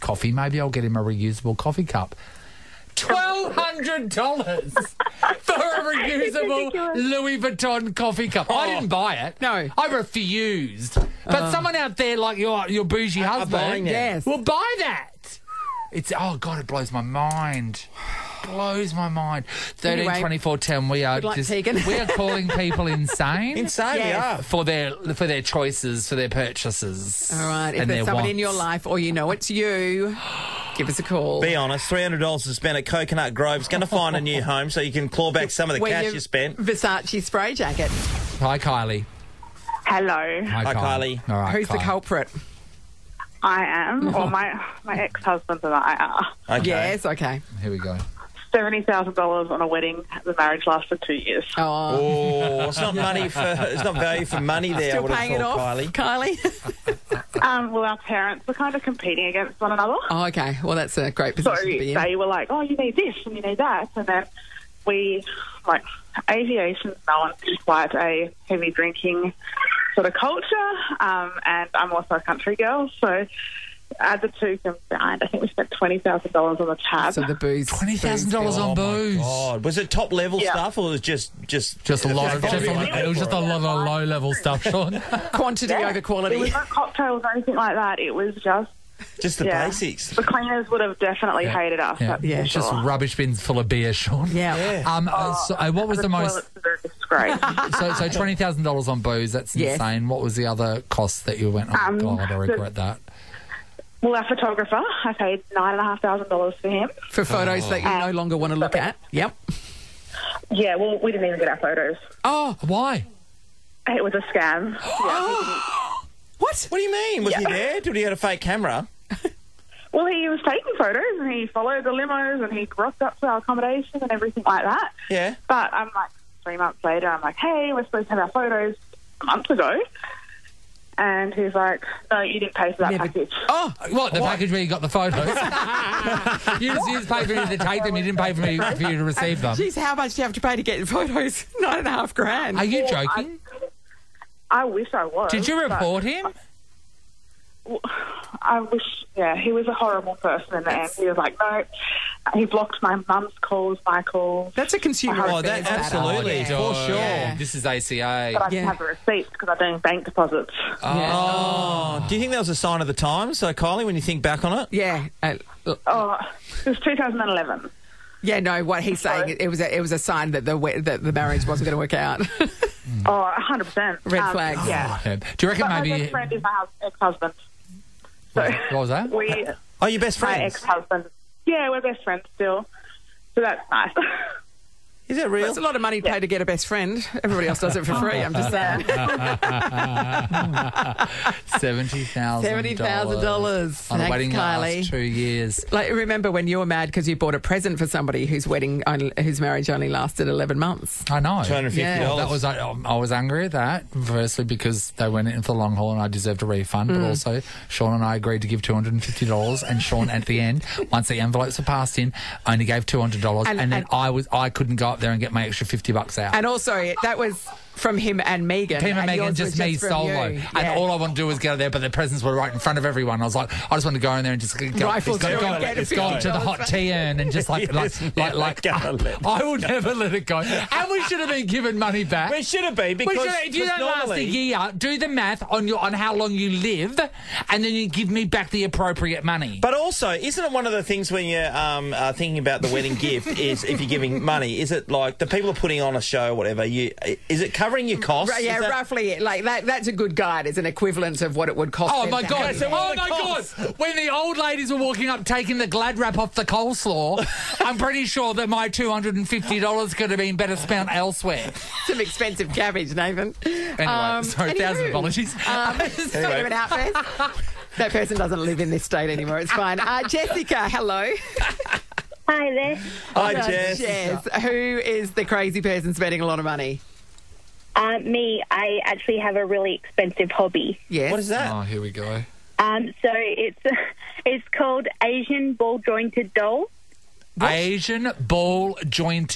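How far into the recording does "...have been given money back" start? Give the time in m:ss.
3:51.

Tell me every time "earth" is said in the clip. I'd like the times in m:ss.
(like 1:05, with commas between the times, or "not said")
not said.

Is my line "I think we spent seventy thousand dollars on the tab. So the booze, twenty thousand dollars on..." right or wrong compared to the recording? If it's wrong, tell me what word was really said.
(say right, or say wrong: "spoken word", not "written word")
wrong: "twenty", not "seventy".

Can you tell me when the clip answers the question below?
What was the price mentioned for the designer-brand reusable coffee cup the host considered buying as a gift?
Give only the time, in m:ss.
0:02.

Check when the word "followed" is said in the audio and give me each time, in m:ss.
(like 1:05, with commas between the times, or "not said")
2:01.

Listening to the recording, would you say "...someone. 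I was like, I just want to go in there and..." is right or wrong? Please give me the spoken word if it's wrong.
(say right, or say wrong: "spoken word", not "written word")
wrong: "everyone", not "someone".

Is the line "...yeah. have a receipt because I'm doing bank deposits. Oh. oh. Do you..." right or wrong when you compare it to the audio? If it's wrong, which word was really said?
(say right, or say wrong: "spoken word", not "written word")
right.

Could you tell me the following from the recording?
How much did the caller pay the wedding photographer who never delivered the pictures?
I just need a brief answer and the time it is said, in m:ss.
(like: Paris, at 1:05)
$9,500, at 1:45.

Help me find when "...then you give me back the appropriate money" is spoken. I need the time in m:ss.
3:57.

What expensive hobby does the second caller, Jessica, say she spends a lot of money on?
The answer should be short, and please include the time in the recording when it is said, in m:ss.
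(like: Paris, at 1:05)
Asian ball jointed dolls, at 4:45.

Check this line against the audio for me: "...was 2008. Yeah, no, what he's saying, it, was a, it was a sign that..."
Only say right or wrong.
wrong.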